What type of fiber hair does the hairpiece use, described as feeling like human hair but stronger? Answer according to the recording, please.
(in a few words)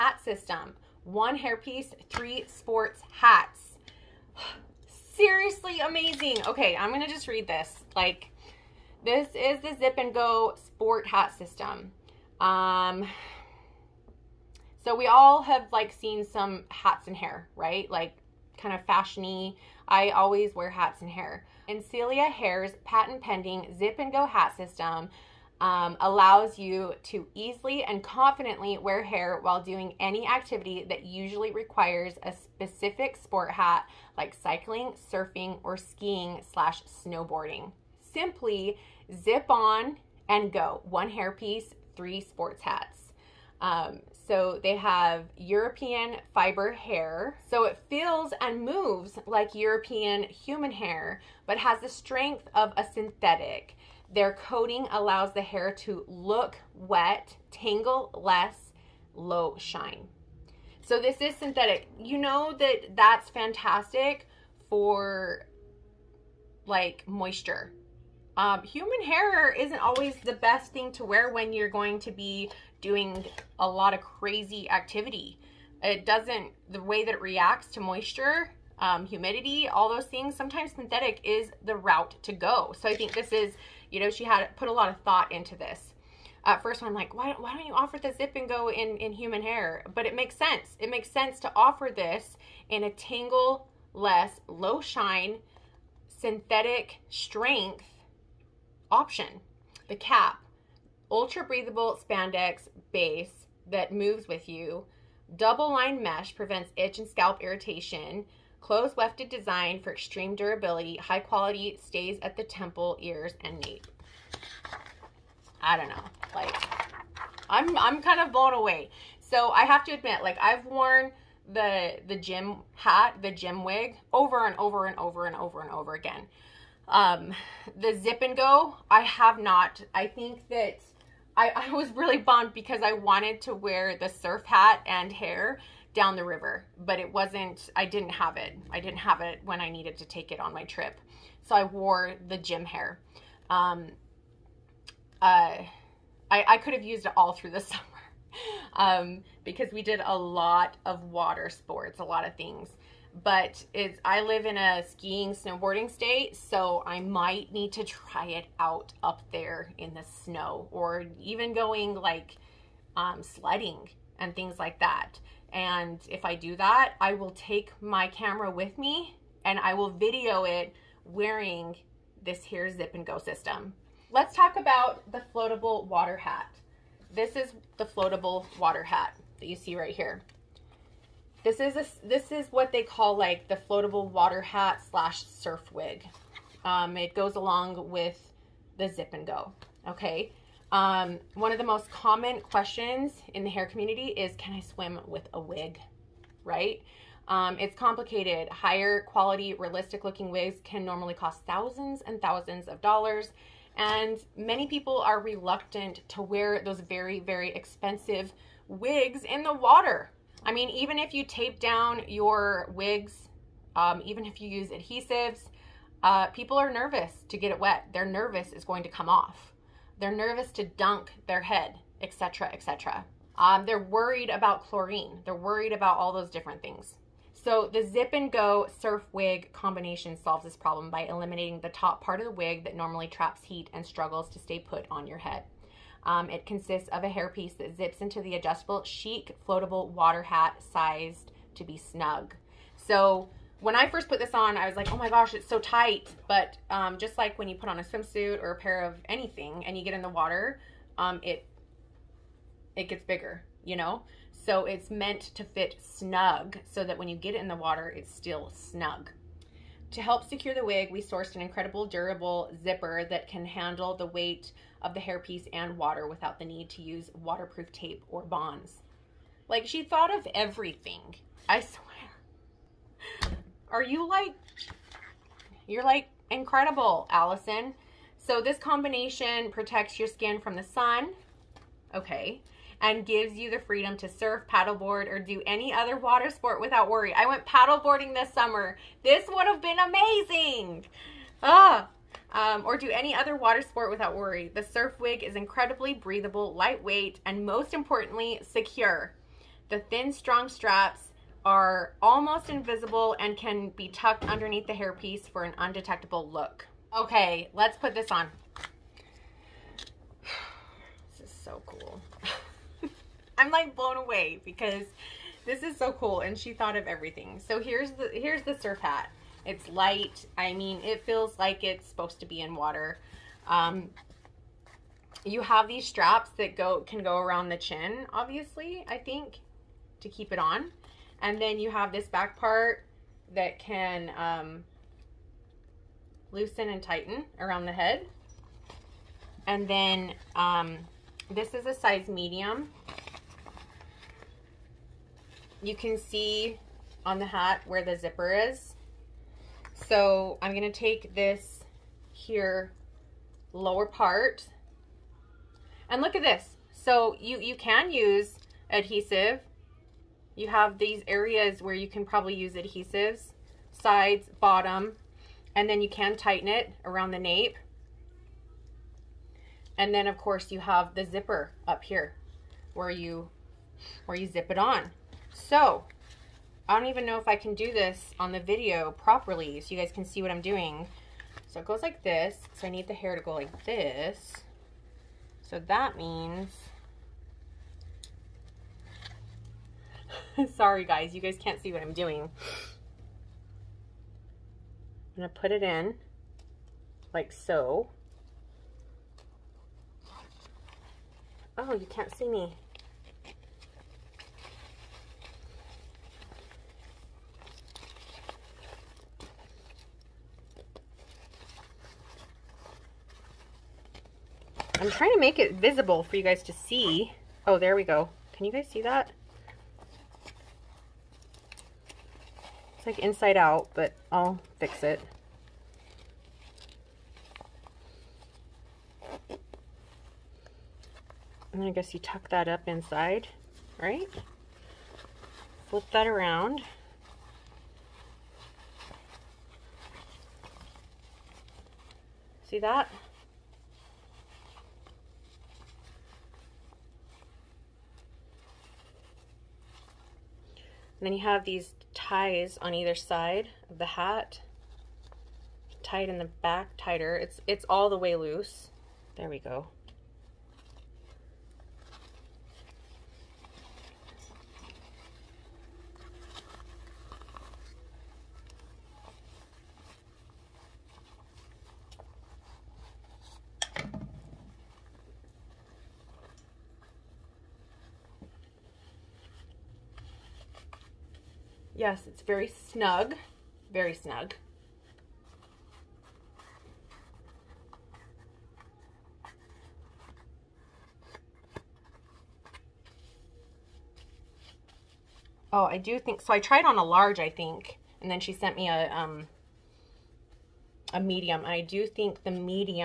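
European fiber hair.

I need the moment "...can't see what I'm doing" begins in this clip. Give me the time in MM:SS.
06:31.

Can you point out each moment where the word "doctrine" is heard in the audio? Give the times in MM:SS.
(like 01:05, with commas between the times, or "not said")
not said.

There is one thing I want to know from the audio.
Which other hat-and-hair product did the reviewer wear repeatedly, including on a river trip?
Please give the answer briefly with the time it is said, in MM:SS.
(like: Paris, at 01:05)
Gym wig, at 02:03.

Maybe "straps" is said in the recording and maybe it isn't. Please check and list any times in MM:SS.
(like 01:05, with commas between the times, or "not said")
05:00, 05:25.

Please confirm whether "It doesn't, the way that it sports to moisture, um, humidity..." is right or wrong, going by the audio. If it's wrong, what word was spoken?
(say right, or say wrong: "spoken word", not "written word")
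wrong: "reacts", not "sports".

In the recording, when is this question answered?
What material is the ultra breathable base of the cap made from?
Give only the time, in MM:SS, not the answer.
01:41.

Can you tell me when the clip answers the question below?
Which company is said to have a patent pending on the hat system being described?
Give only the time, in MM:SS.
00:21.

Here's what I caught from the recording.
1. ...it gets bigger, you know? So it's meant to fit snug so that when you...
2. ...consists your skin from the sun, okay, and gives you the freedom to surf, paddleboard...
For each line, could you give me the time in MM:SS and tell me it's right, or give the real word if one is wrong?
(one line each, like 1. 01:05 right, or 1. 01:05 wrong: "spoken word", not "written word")
1. 04:12 right
2. 04:39 wrong: "protects", not "consists".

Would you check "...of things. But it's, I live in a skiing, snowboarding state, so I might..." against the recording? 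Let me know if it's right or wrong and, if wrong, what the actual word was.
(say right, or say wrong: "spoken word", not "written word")
right.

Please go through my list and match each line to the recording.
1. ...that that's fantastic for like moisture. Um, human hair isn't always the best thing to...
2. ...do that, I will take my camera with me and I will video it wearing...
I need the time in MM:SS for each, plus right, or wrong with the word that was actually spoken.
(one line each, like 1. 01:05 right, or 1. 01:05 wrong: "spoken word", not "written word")
1. 01:02 right
2. 02:46 right.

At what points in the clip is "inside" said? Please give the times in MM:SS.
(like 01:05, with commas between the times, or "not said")
07:02, 07:12.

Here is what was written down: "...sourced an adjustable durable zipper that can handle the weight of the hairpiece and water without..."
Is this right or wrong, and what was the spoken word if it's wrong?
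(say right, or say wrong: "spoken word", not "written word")
wrong: "incredible", not "adjustable".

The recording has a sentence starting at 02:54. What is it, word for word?
Let's talk about the floatable water hat.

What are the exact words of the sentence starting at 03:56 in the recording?
Um, it consists of a hairpiece that zips into the adjustable chic floatable water hat sized to be snug.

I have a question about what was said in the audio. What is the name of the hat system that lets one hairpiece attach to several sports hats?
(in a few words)
Zip and Go Sport Hat System.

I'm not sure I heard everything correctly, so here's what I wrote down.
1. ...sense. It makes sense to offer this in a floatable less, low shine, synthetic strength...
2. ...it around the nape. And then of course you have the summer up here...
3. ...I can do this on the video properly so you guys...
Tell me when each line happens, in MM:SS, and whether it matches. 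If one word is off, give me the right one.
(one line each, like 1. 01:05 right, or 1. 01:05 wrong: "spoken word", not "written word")
1. 01:30 wrong: "tangle", not "floatable"
2. 06:06 wrong: "zipper", not "summer"
3. 06:17 right.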